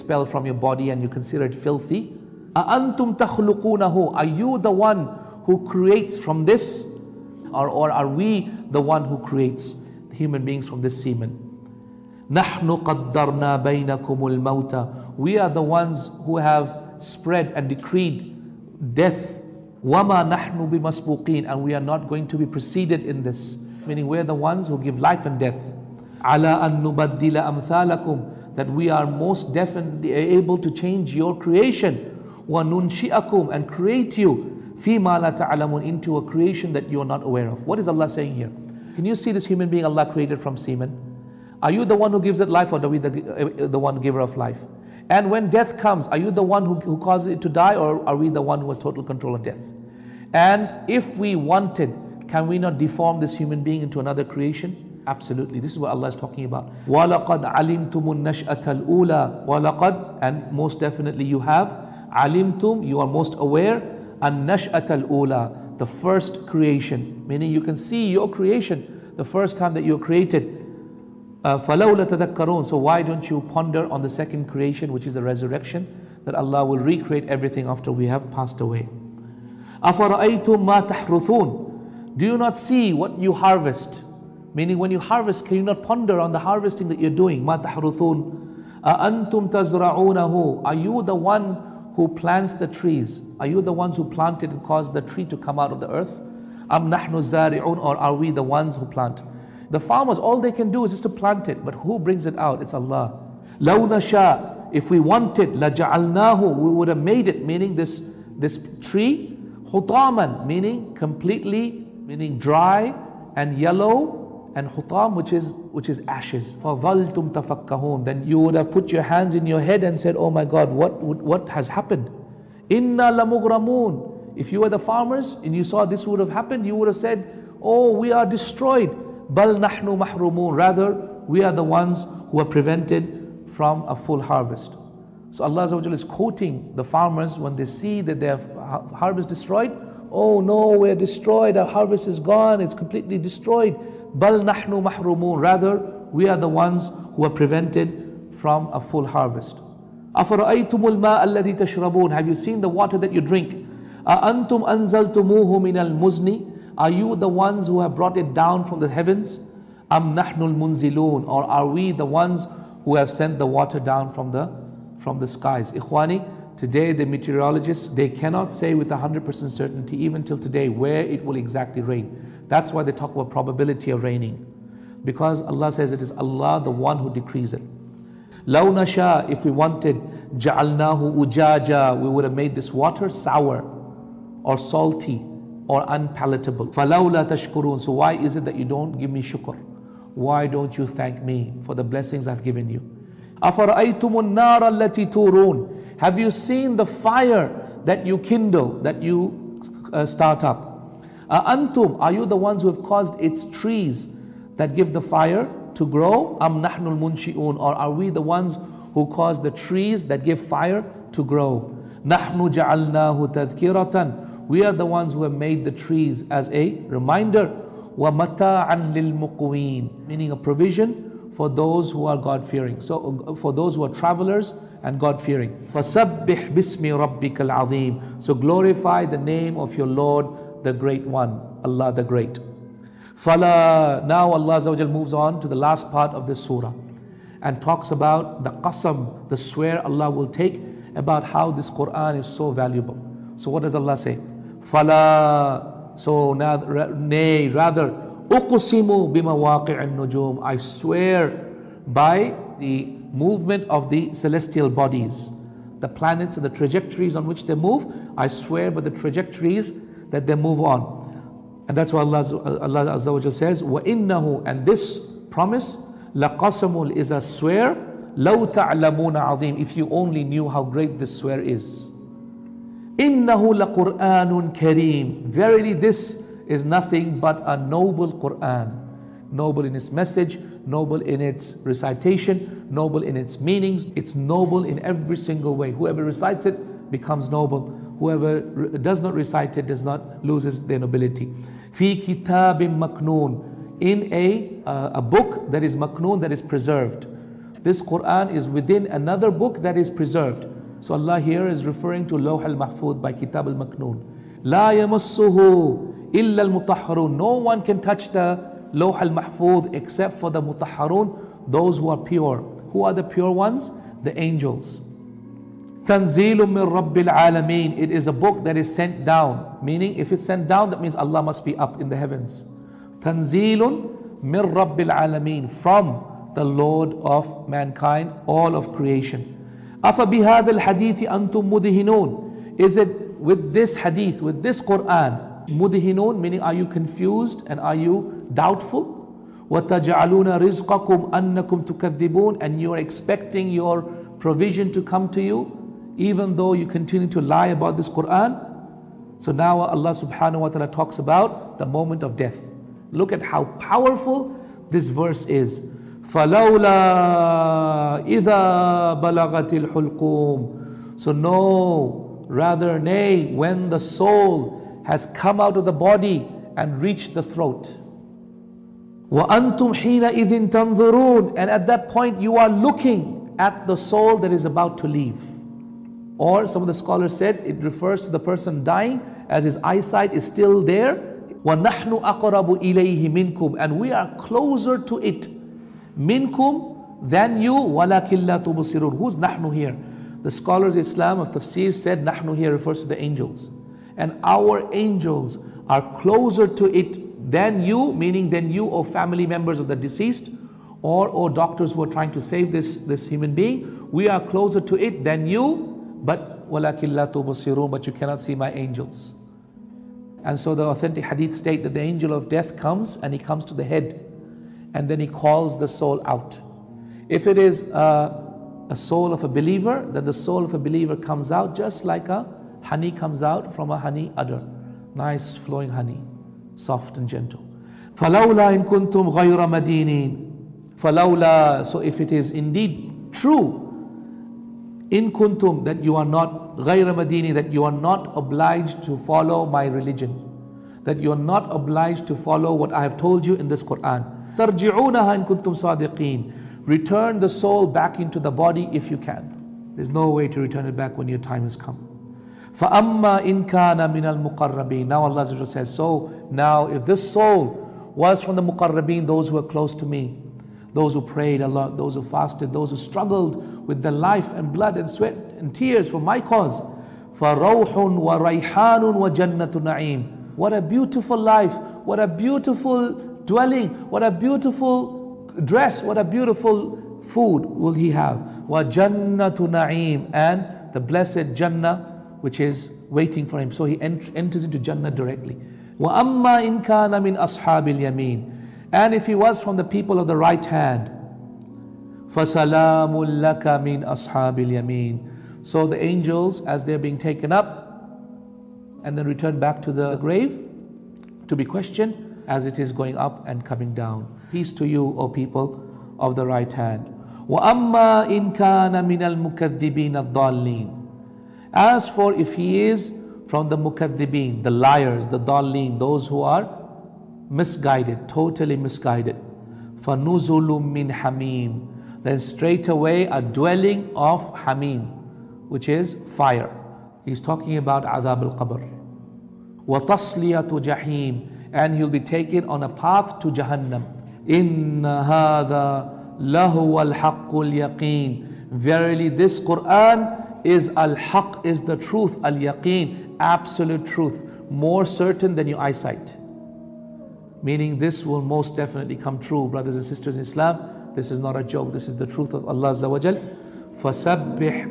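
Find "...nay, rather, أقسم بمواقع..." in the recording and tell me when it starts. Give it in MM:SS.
04:06.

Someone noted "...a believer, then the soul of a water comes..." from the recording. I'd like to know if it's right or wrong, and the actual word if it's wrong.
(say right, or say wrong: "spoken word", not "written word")
wrong: "believer", not "water".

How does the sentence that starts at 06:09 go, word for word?
وَأَنْتُمْ حِينَئِذٍ تَنْظُرُونَ And at that point you are looking at the soul that is about to leave.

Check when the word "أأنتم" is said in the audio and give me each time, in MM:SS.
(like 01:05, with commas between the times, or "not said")
02:34.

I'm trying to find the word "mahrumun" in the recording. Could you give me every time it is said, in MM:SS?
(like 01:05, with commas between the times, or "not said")
02:09, 02:24.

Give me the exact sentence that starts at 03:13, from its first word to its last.
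أَفَرَأَيْتُمُ النَّارَ الَّتِي تُورُونَ have you seen the fire that you kindle, that you uh, start up?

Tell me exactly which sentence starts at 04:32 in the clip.
إِنَّهُ لَقُرْآنٌ كَرِيمٌ Verily this is nothing but a noble Qur'an.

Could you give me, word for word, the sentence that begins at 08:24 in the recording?
Peace to you, O people of the right hand.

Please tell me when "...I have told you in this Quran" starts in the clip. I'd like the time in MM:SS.
07:22.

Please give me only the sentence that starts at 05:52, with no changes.
Look at how powerful this verse is.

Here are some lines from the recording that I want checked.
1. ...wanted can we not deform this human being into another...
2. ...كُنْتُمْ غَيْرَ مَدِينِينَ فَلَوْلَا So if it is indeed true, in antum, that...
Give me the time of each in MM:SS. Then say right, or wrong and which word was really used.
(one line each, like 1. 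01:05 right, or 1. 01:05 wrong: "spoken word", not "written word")
1. 00:51 right
2. 07:08 wrong: "kuntum", not "antum".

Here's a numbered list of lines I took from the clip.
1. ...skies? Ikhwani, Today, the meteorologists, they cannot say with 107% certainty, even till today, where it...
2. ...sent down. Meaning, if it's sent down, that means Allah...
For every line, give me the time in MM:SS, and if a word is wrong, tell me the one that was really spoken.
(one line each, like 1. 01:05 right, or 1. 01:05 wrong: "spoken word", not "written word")
1. 02:45 wrong: "100", not "107"
2. 05:18 right.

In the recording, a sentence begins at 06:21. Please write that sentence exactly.
وَنَحْنُ أَقْرَبُ إِلَيْهِ مِنْكُمْ And we are closer to it.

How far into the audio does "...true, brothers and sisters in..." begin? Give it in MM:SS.
09:09.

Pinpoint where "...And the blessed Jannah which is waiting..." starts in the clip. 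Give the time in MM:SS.
08:00.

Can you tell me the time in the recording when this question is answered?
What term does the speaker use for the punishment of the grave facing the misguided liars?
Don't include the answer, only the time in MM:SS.
08:47.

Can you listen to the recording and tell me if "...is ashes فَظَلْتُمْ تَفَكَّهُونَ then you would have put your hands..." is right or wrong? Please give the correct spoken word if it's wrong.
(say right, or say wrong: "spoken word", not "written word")
right.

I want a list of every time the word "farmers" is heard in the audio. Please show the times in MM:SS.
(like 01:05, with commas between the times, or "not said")
01:39, 02:04, 02:16.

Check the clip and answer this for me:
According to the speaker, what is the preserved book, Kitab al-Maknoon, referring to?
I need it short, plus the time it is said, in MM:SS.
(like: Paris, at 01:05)
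Lawh al-Mahfud, at 05:02.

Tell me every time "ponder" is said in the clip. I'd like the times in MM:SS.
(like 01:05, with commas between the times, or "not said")
01:13, 01:25.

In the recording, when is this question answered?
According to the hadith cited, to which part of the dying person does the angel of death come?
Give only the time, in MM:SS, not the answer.
06:53.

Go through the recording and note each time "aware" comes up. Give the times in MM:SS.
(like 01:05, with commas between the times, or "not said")
00:37, 01:03.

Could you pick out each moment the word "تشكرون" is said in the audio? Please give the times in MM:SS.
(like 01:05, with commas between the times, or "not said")
03:07.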